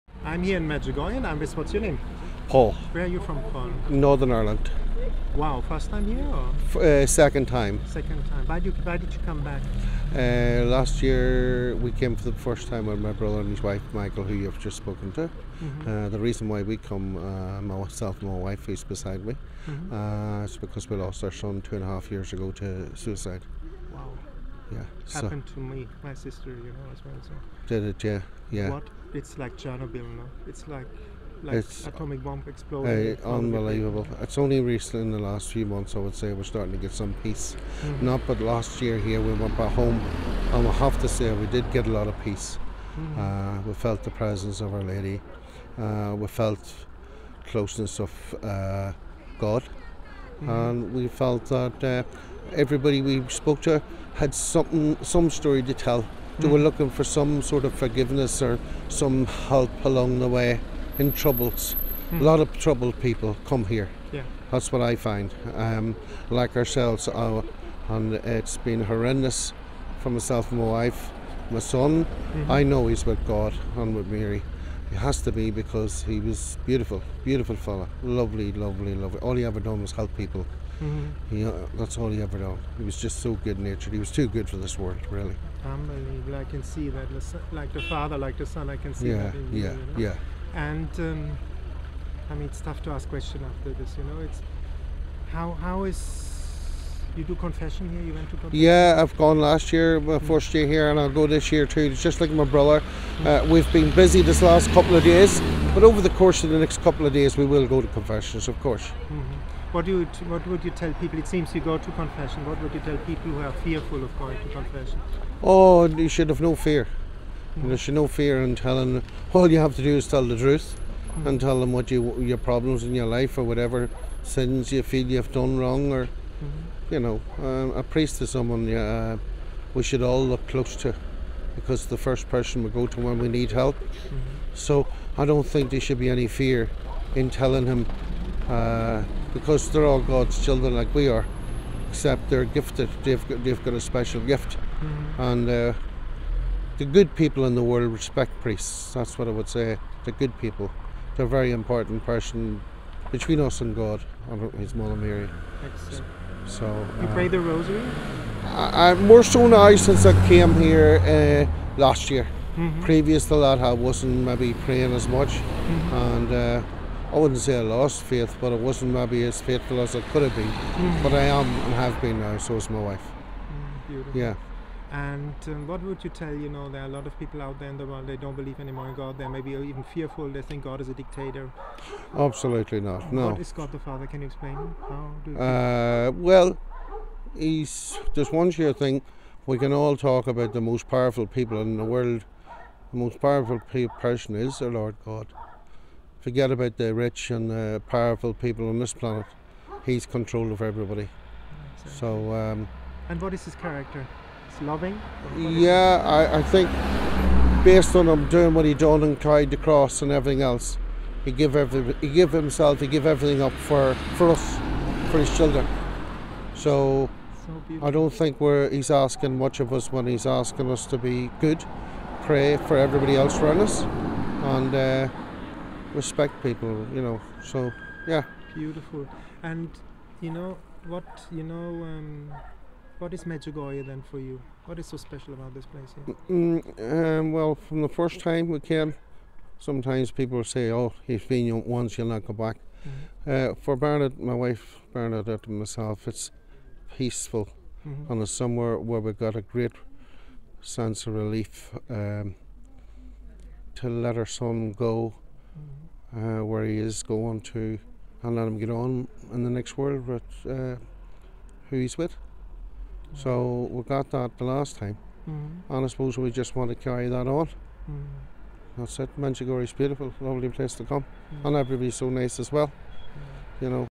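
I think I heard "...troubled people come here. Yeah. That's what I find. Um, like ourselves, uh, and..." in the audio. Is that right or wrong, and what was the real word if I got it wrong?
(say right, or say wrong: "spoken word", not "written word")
right.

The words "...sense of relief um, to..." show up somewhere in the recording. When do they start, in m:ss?
4:10.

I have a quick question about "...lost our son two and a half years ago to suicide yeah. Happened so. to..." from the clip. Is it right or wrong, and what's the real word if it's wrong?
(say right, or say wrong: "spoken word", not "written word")
right.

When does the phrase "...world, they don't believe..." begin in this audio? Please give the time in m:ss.
2:57.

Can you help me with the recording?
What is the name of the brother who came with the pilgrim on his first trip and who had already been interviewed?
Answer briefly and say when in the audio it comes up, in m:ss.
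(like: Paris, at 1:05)
Michael, at 0:13.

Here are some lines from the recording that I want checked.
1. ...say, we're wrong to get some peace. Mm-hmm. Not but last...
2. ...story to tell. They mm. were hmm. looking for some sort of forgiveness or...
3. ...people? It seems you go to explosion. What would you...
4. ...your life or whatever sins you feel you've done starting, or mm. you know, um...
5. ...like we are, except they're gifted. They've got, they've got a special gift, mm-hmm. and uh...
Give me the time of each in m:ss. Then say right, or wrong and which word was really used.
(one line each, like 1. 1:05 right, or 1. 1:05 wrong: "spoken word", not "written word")
1. 0:36 wrong: "starting", not "wrong"
2. 0:55 right
3. 1:50 wrong: "confession", not "explosion"
4. 2:02 wrong: "wrong", not "starting"
5. 2:20 right.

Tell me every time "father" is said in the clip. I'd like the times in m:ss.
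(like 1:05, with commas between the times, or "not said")
1:27, 3:03.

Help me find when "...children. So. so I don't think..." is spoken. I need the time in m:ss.
3:35.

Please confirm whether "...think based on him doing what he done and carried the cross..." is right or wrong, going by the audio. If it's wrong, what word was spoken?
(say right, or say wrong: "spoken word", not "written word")
right.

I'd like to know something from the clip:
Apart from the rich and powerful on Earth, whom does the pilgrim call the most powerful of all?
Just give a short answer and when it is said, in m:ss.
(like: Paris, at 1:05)
The Lord God, at 3:14.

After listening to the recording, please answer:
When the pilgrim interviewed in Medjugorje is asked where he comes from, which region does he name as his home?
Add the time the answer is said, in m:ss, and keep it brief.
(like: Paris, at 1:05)
Northern Ireland, at 0:03.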